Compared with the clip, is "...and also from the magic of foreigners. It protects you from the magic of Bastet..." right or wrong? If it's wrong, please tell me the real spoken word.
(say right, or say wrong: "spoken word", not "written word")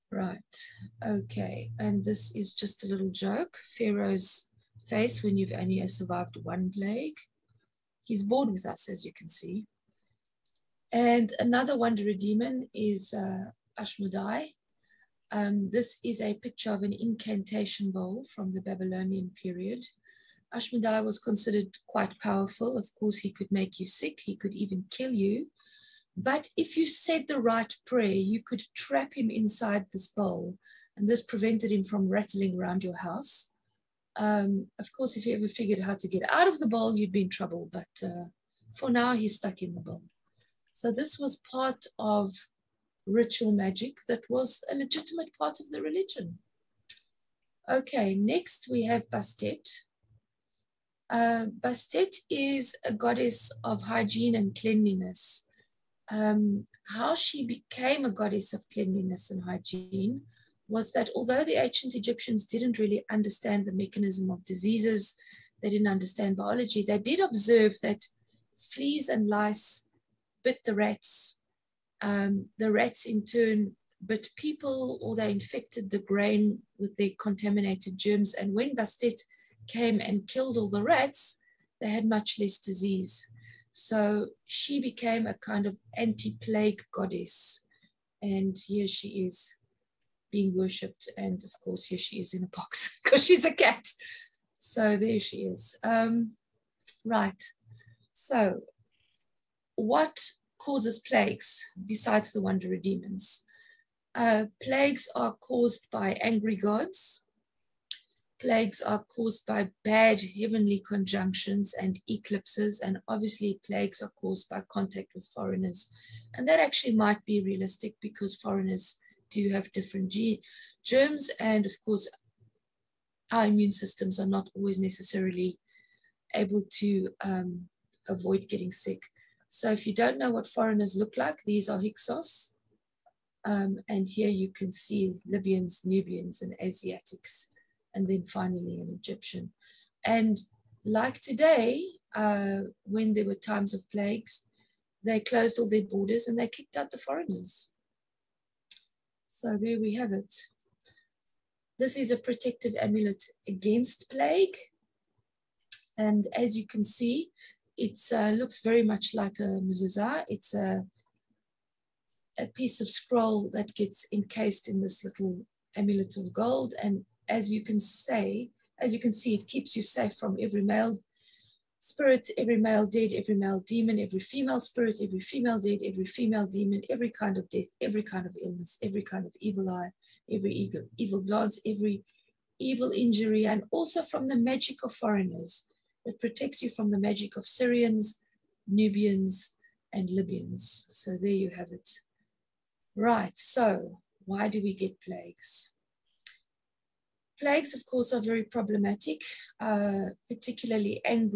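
wrong: "Syrians", not "Bastet".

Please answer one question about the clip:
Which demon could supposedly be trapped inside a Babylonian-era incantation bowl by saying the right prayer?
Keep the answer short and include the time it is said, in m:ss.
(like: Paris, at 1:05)
Ashmodai, at 0:13.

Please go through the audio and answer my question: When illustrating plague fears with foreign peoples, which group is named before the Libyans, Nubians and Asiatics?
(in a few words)
Hyksos.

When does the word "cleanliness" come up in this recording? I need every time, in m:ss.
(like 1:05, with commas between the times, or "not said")
0:54, 0:58.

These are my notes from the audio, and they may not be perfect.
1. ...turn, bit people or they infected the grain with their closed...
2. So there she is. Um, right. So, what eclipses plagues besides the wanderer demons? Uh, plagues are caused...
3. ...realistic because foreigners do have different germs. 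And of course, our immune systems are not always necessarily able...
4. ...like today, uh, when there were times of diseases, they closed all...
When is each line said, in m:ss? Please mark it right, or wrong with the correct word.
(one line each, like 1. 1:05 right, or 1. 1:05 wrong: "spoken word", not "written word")
1. 1:13 wrong: "contaminated", not "closed"
2. 1:34 wrong: "causes", not "eclipses"
3. 1:57 right
4. 2:20 wrong: "plagues", not "diseases".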